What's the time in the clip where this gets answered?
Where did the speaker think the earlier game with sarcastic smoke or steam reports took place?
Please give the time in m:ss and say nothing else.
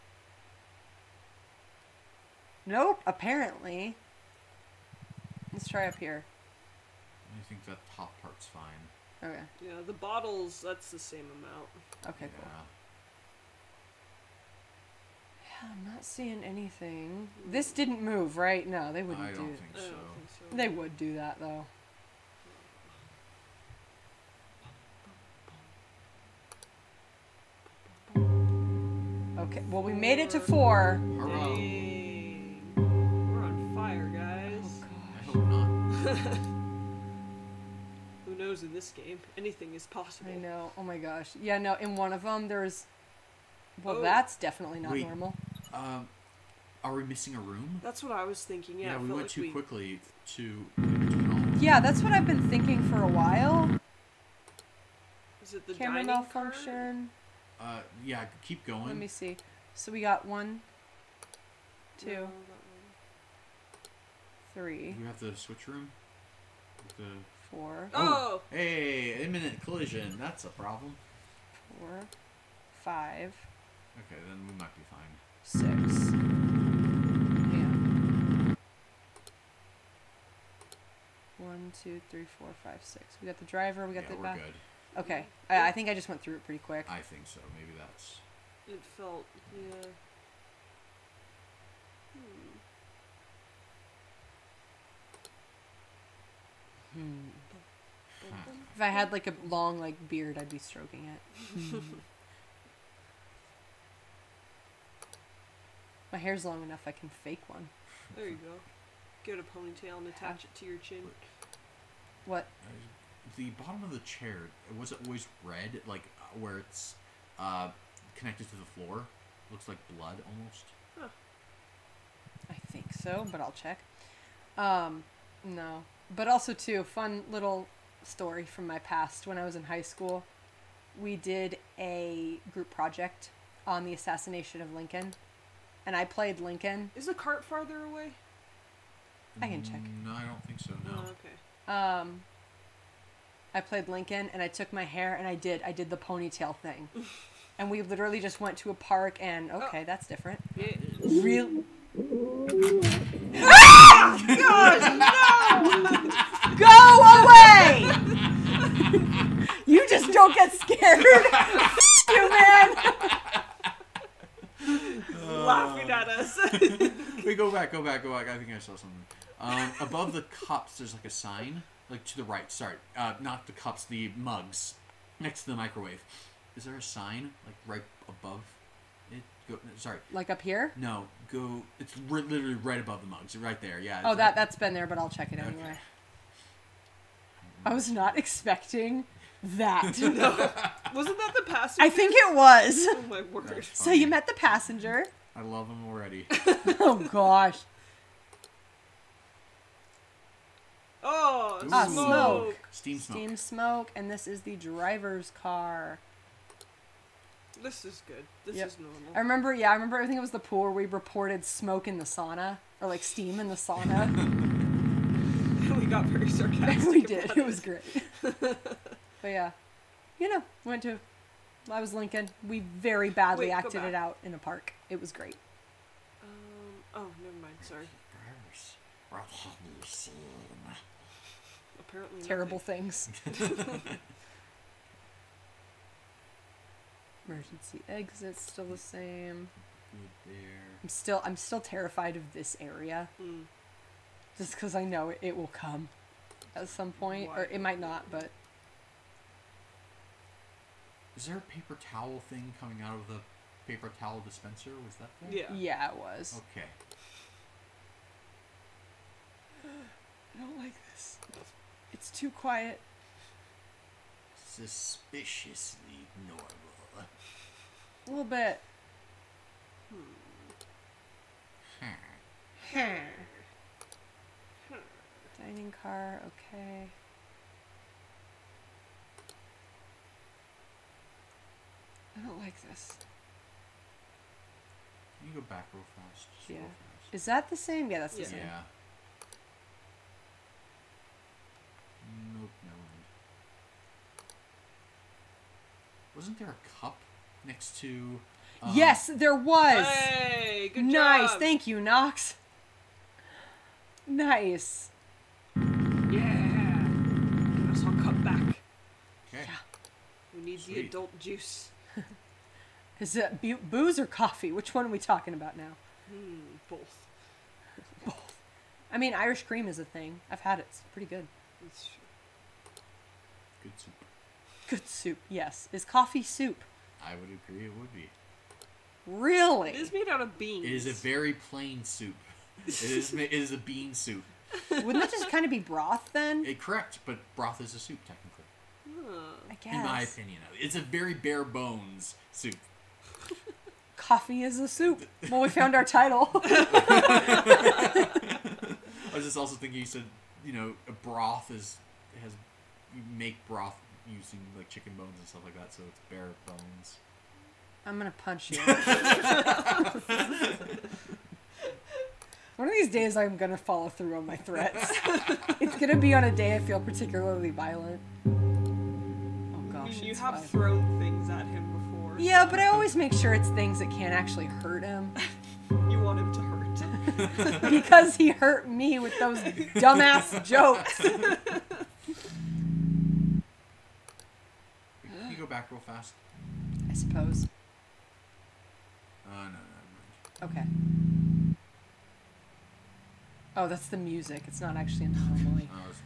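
3:29.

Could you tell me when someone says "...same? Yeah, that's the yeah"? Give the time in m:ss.
4:47.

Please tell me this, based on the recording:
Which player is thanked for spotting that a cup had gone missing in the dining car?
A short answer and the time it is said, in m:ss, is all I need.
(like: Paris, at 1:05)
Nox, at 5:01.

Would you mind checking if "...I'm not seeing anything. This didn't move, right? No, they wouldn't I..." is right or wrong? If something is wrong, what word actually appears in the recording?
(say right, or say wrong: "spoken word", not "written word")
right.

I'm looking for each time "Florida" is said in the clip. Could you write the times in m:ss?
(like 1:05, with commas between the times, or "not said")
not said.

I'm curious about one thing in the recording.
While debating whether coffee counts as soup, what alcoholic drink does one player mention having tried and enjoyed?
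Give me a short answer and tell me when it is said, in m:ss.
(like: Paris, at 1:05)
Irish cream, at 5:19.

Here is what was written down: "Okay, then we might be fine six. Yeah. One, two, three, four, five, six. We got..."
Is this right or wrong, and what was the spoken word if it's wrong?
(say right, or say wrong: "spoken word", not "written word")
right.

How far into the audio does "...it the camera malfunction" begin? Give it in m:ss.
0:55.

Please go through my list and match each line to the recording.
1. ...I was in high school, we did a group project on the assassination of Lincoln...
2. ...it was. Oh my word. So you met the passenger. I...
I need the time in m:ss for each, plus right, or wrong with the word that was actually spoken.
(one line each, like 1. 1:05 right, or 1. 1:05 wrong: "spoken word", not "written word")
1. 2:09 right
2. 3:12 right.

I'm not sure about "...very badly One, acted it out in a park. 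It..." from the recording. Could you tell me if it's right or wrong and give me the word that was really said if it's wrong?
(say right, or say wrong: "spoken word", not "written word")
wrong: "Wait", not "One".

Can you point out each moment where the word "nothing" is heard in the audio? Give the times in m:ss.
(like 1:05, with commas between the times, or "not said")
3:52.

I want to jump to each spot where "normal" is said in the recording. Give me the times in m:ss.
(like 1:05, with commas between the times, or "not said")
0:45, 3:28, 4:26.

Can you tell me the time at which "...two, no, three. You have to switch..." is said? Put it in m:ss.
1:01.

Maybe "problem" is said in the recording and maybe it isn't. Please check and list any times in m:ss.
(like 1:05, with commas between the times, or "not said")
1:10.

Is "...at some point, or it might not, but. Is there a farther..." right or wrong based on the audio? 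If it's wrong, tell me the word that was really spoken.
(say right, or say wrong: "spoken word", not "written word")
wrong: "paper", not "farther".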